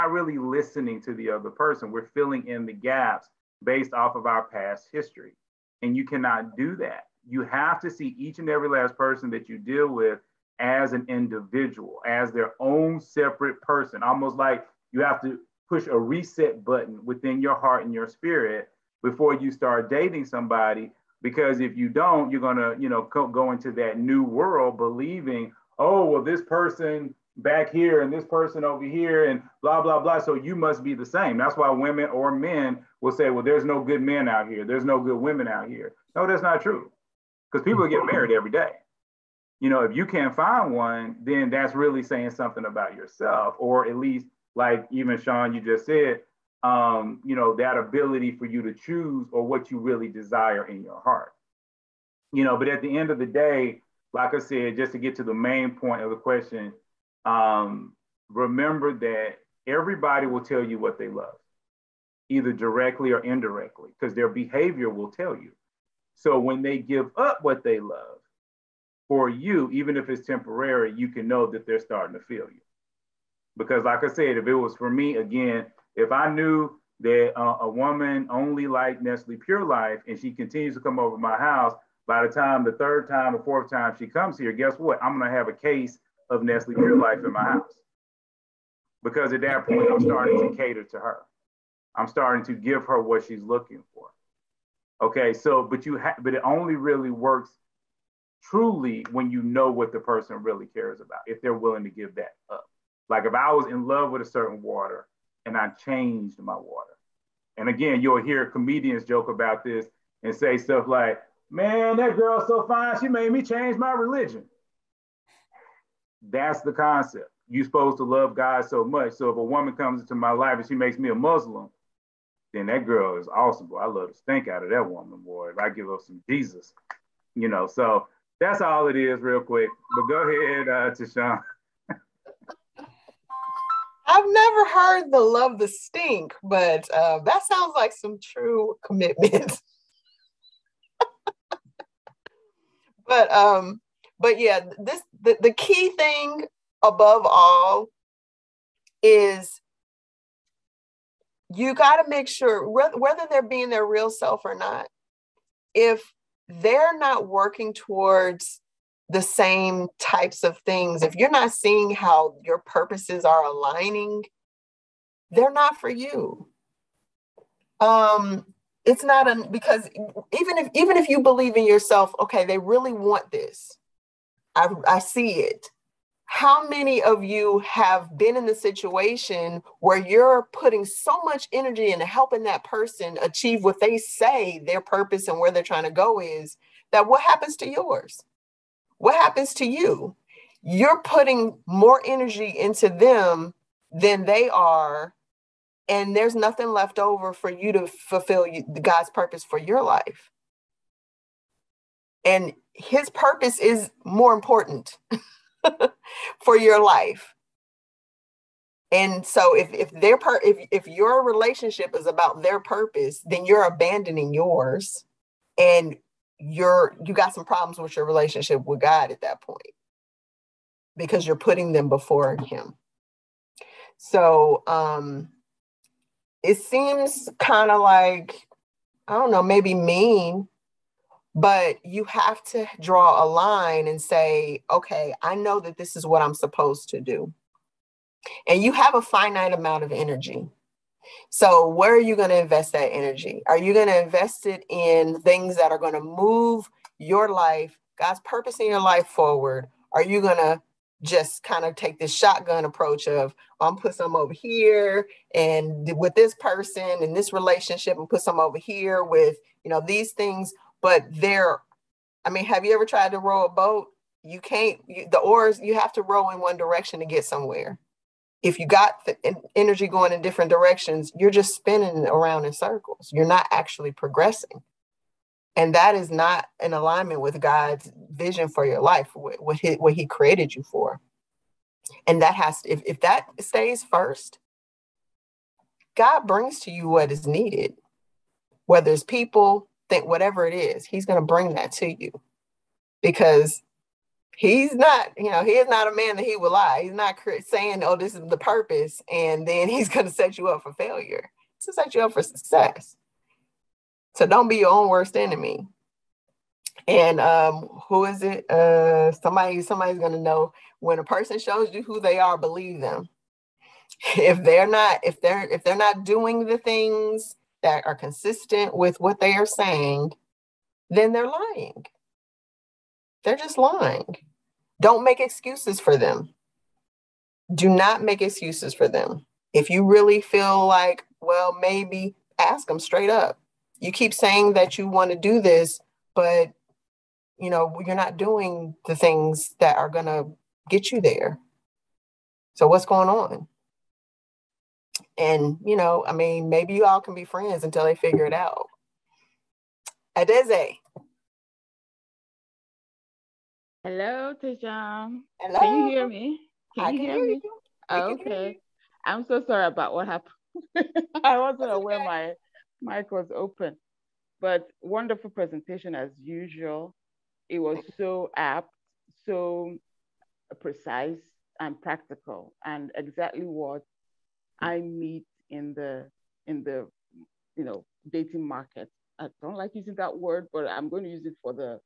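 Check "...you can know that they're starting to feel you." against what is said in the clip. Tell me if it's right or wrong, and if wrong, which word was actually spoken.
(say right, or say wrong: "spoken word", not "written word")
right.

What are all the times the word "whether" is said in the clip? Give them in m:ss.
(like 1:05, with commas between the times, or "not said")
2:32, 4:48.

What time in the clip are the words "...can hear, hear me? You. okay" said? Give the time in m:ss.
5:56.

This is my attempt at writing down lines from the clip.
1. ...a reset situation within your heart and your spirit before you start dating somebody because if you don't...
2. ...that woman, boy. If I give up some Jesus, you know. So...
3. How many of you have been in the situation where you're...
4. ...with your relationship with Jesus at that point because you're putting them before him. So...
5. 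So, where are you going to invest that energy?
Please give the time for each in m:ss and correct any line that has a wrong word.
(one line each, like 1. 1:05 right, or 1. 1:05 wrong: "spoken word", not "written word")
1. 0:15 wrong: "button", not "situation"
2. 2:04 right
3. 2:56 right
4. 3:37 wrong: "God", not "Jesus"
5. 4:01 right.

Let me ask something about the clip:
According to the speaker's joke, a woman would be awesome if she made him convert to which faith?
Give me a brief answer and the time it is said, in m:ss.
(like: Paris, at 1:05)
Muslim, at 2:01.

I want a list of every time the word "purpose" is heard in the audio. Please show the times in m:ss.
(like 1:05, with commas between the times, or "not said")
2:42, 3:04, 3:19, 3:23, 3:32, 4:08, 4:58.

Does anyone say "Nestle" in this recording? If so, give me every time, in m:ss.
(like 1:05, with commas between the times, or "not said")
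1:19, 1:26.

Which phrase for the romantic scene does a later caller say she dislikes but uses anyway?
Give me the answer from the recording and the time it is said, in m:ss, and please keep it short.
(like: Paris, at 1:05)
Dating market, at 6:18.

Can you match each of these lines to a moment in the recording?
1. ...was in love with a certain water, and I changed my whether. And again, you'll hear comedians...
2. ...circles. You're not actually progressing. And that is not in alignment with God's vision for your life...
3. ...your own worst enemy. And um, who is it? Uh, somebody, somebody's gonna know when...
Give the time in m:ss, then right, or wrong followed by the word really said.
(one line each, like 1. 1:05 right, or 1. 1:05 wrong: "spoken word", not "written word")
1. 1:43 wrong: "water", not "whether"
2. 4:32 right
3. 5:04 right.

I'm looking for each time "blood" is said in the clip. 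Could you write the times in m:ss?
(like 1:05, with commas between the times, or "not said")
not said.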